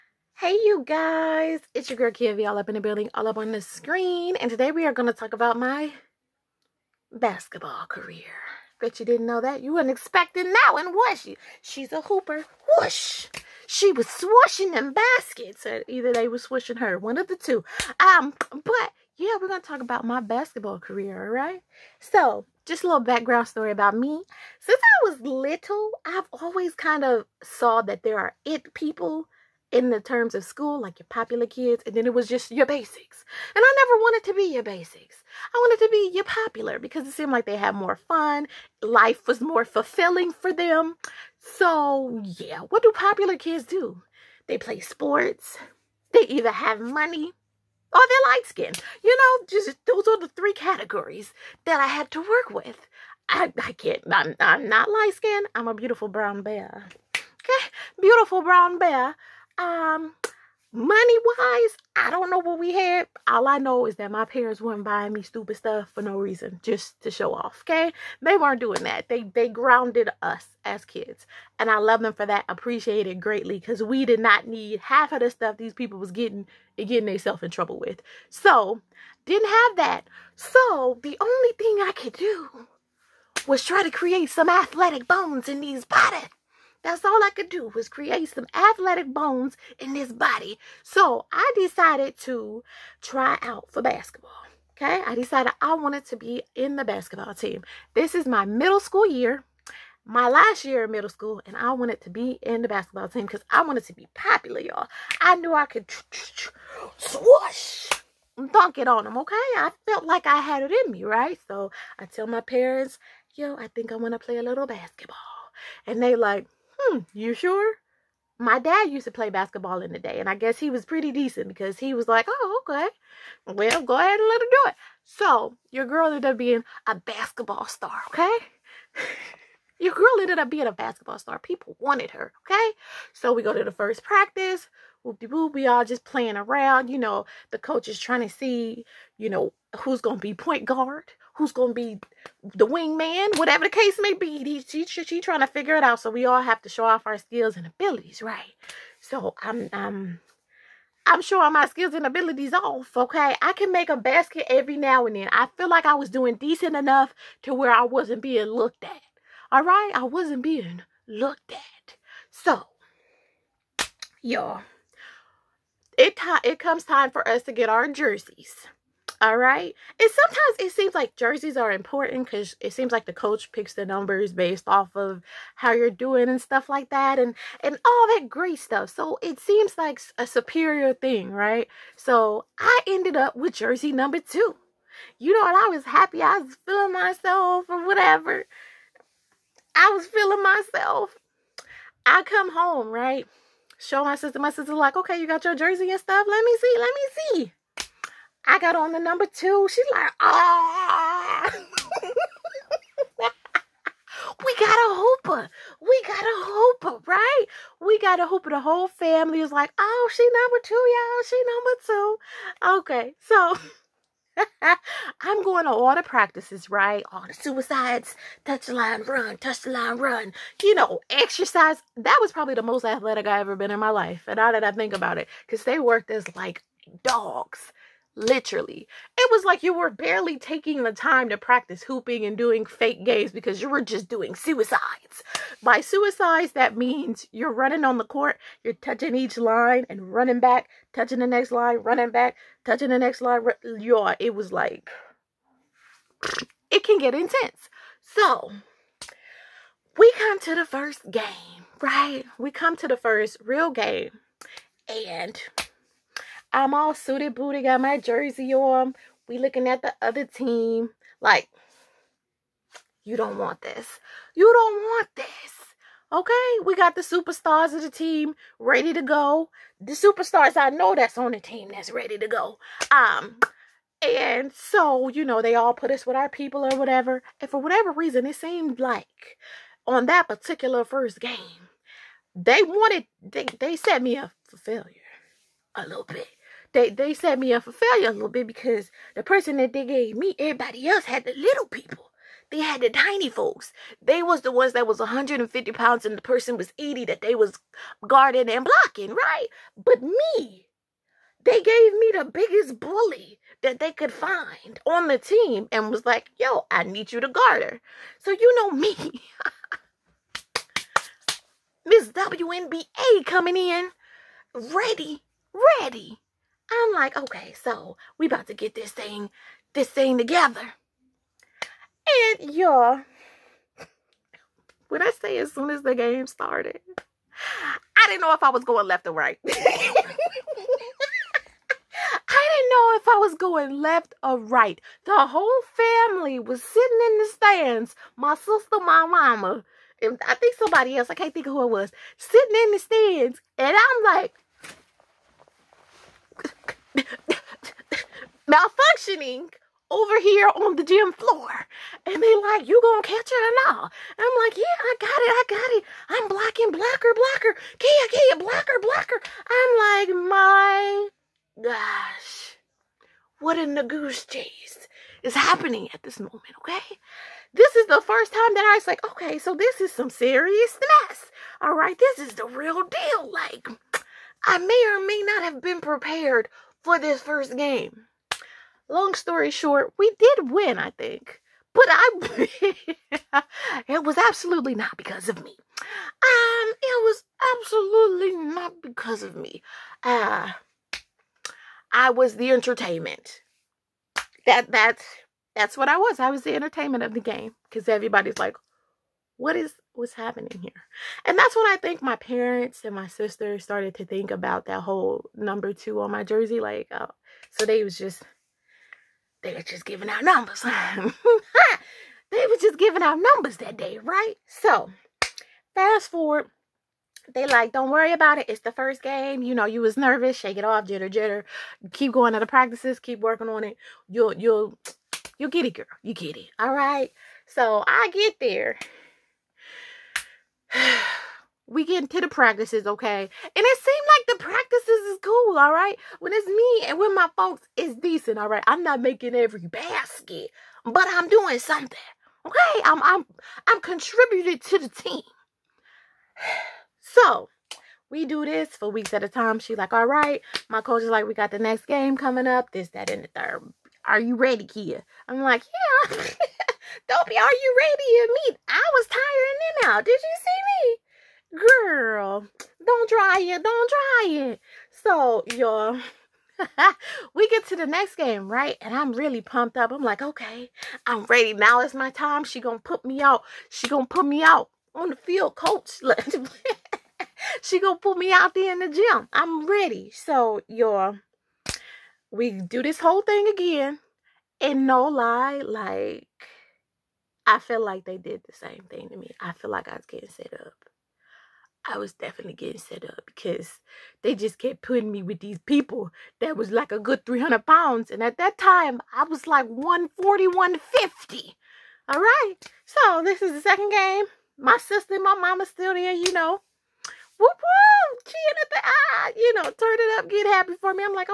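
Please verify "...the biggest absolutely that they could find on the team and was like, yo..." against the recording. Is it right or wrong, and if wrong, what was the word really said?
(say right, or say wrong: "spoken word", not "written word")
wrong: "bully", not "absolutely".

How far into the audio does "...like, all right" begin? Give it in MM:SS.
07:29.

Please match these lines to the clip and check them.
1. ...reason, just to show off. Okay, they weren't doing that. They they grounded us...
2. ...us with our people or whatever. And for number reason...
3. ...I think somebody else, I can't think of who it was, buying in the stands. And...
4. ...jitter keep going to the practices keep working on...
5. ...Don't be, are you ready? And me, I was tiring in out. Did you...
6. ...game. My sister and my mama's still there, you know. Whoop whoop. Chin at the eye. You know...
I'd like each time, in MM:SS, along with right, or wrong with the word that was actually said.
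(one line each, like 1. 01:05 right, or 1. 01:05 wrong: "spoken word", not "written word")
1. 01:06 right
2. 04:35 wrong: "whatever", not "number"
3. 05:40 wrong: "sitting", not "buying"
4. 07:01 right
5. 07:37 right
6. 08:23 right.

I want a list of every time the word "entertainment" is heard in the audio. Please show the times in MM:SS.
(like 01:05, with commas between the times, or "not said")
06:32, 06:36.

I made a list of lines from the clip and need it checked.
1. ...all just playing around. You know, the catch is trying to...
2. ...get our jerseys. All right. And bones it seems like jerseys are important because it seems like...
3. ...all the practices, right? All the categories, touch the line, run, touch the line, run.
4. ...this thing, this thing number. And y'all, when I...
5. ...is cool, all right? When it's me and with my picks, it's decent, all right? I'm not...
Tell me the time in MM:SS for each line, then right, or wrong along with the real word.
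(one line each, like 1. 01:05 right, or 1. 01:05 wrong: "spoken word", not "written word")
1. 02:15 wrong: "coach", not "catch"
2. 02:47 wrong: "sometimes", not "bones"
3. 03:35 wrong: "suicides", not "categories"
4. 05:18 wrong: "together", not "number"
5. 07:15 wrong: "folks", not "picks".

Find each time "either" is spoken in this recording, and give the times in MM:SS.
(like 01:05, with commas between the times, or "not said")
00:15, 00:46.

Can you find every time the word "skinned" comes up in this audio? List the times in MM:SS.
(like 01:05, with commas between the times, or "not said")
00:48, 00:55.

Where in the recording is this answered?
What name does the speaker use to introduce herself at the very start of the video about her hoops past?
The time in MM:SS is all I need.
00:02.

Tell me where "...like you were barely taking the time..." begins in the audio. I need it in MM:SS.
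03:49.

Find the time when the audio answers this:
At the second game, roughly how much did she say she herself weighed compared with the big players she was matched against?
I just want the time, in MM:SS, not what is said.
08:19.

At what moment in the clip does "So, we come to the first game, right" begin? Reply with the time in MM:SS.
04:08.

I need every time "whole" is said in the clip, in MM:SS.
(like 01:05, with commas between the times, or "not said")
03:28, 05:35, 06:44, 08:02.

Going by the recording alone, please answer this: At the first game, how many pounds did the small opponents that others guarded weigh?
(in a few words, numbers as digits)
80.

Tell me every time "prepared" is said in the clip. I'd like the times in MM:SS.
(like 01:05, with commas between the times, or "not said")
06:15.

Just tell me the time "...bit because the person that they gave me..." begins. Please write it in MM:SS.
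04:48.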